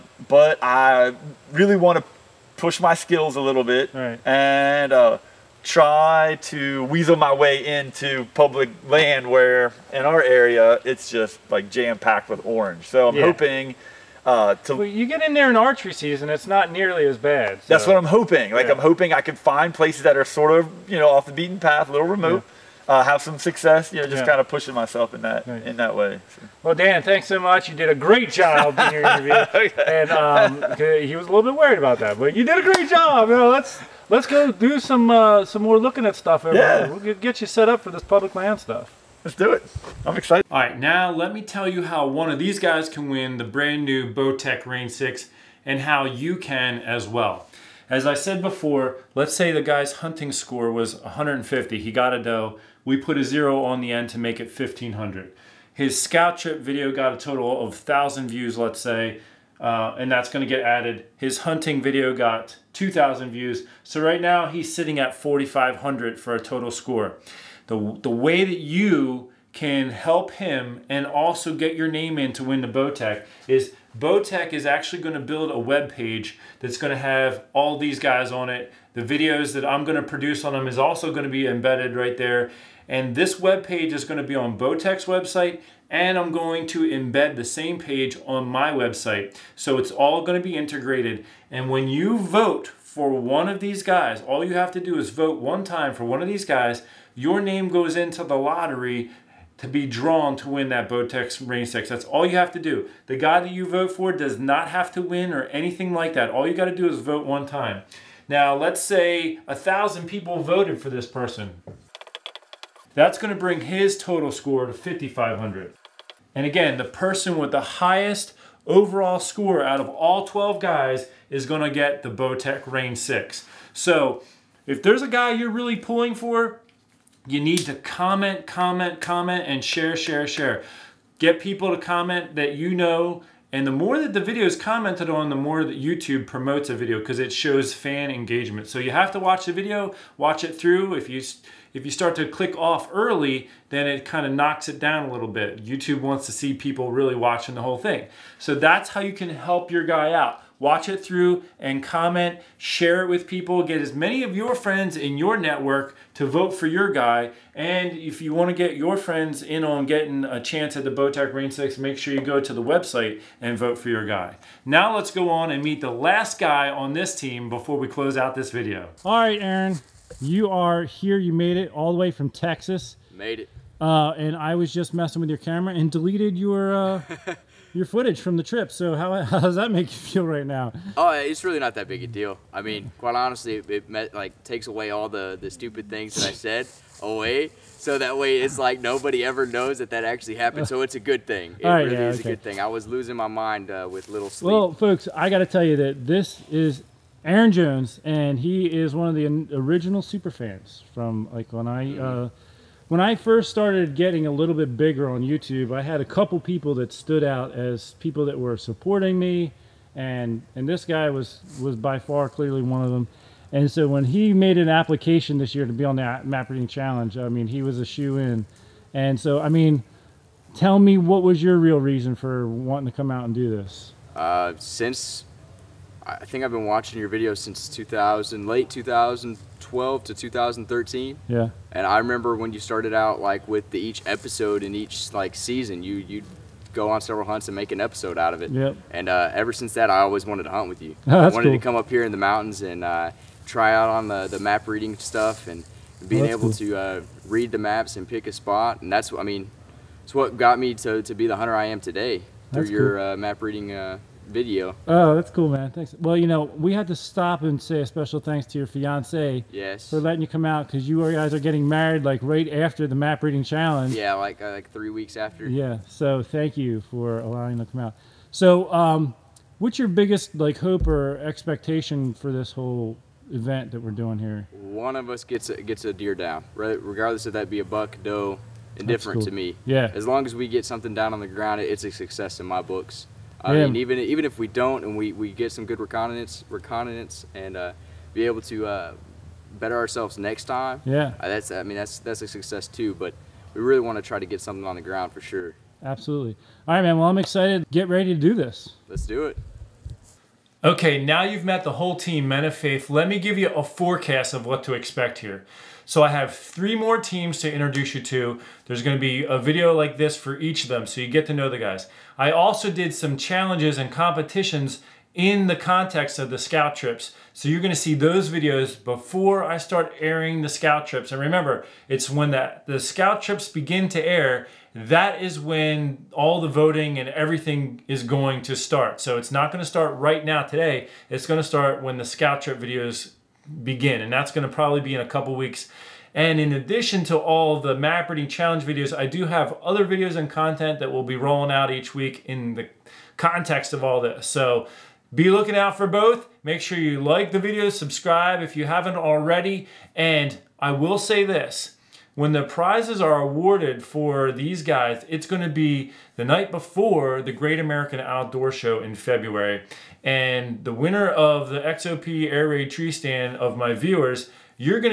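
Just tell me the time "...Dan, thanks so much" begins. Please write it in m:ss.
0:26.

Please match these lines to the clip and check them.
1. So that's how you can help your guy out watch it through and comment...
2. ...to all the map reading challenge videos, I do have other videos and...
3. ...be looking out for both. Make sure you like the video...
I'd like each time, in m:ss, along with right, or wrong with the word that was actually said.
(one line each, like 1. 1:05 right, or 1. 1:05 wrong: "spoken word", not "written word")
1. 2:28 right
2. 5:37 right
3. 5:45 right.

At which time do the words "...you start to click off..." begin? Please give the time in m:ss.
2:21.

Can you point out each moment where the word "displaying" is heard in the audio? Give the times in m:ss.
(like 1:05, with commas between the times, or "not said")
not said.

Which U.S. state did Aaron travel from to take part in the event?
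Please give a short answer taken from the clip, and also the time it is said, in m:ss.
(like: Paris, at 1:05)
Texas, at 2:52.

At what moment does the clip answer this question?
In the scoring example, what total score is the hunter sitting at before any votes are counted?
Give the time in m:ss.
1:05.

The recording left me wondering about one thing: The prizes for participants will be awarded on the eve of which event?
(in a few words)
Great American Outdoor Show.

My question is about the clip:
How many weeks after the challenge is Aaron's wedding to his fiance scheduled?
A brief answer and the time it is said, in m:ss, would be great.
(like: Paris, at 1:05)
3, at 4:24.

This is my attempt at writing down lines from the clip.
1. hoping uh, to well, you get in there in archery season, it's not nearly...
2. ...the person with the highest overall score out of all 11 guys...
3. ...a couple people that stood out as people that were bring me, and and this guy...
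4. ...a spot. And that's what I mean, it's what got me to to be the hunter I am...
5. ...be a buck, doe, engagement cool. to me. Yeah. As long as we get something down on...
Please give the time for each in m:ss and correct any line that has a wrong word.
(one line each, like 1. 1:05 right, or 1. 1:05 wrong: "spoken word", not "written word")
1. 0:13 right
2. 1:56 wrong: "12", not "11"
3. 3:26 wrong: "supporting", not "bring"
4. 4:08 right
5. 4:37 wrong: "indifferent", not "engagement".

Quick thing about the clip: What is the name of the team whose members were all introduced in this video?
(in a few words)
Men of Faith.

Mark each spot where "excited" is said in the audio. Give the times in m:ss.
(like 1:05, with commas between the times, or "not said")
0:40, 4:57.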